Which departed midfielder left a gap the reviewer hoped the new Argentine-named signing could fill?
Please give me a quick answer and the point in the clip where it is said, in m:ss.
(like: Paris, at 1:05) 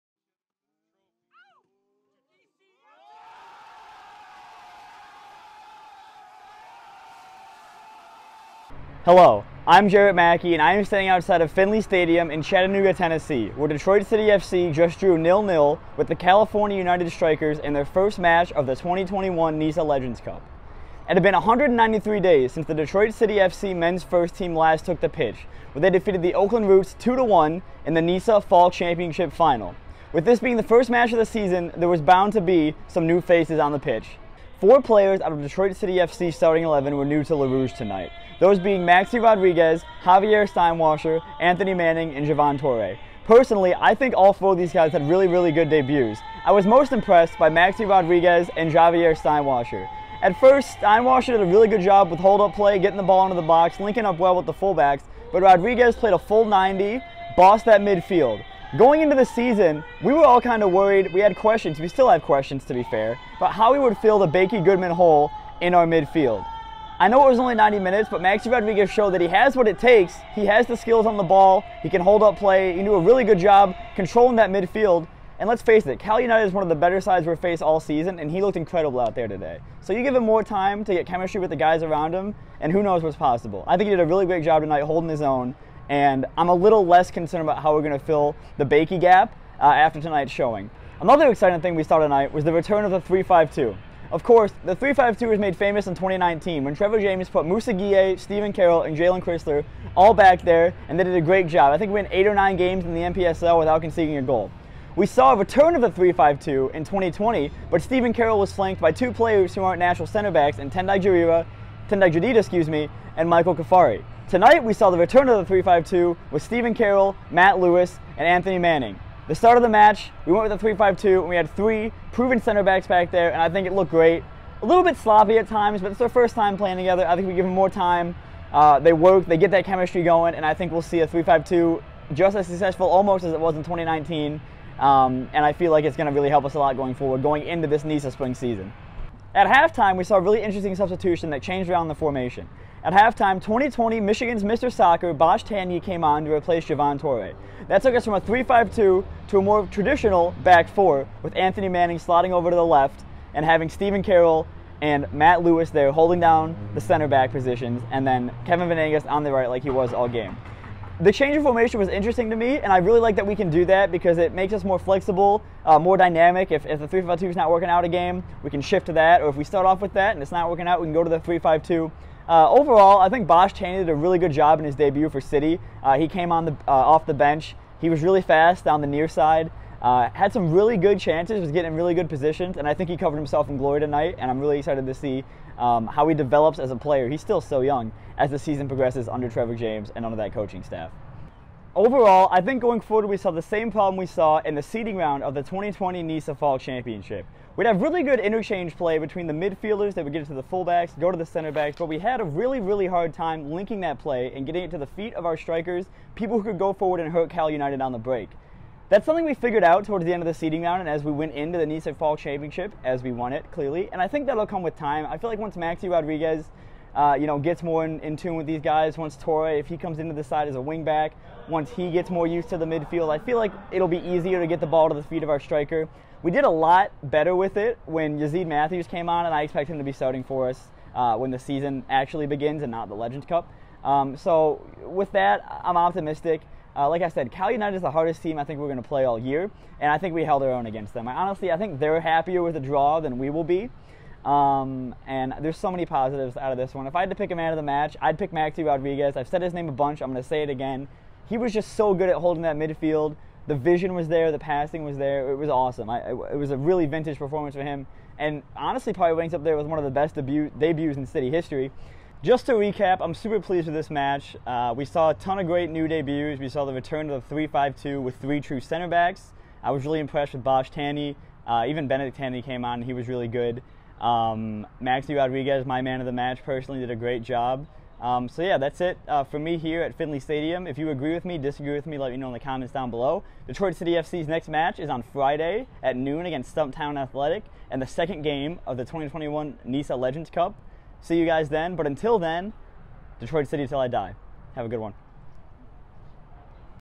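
Bakie Goodman, at 1:04.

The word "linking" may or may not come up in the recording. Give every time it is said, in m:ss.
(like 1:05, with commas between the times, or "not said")
0:53, 3:23.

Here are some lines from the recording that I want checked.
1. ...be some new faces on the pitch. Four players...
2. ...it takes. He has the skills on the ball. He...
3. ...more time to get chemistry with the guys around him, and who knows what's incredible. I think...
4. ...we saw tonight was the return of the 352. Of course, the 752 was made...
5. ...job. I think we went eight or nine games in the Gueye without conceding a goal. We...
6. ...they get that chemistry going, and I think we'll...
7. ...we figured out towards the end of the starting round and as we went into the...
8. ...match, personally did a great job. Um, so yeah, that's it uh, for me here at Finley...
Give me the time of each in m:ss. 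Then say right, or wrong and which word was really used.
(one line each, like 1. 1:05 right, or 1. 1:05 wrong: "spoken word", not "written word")
1. 0:32 right
2. 1:09 right
3. 1:20 wrong: "possible", not "incredible"
4. 1:31 wrong: "352", not "752"
5. 1:41 wrong: "NPSL", not "Gueye"
6. 2:09 right
7. 3:29 wrong: "seeding", not "starting"
8. 4:36 right.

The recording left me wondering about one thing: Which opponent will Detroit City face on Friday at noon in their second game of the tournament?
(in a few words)
Stumptown Athletic.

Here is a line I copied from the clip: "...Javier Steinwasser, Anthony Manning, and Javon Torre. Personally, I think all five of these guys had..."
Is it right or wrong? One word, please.
wrong.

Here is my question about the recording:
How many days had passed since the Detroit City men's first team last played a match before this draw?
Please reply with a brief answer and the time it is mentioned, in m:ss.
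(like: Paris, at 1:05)
193, at 0:21.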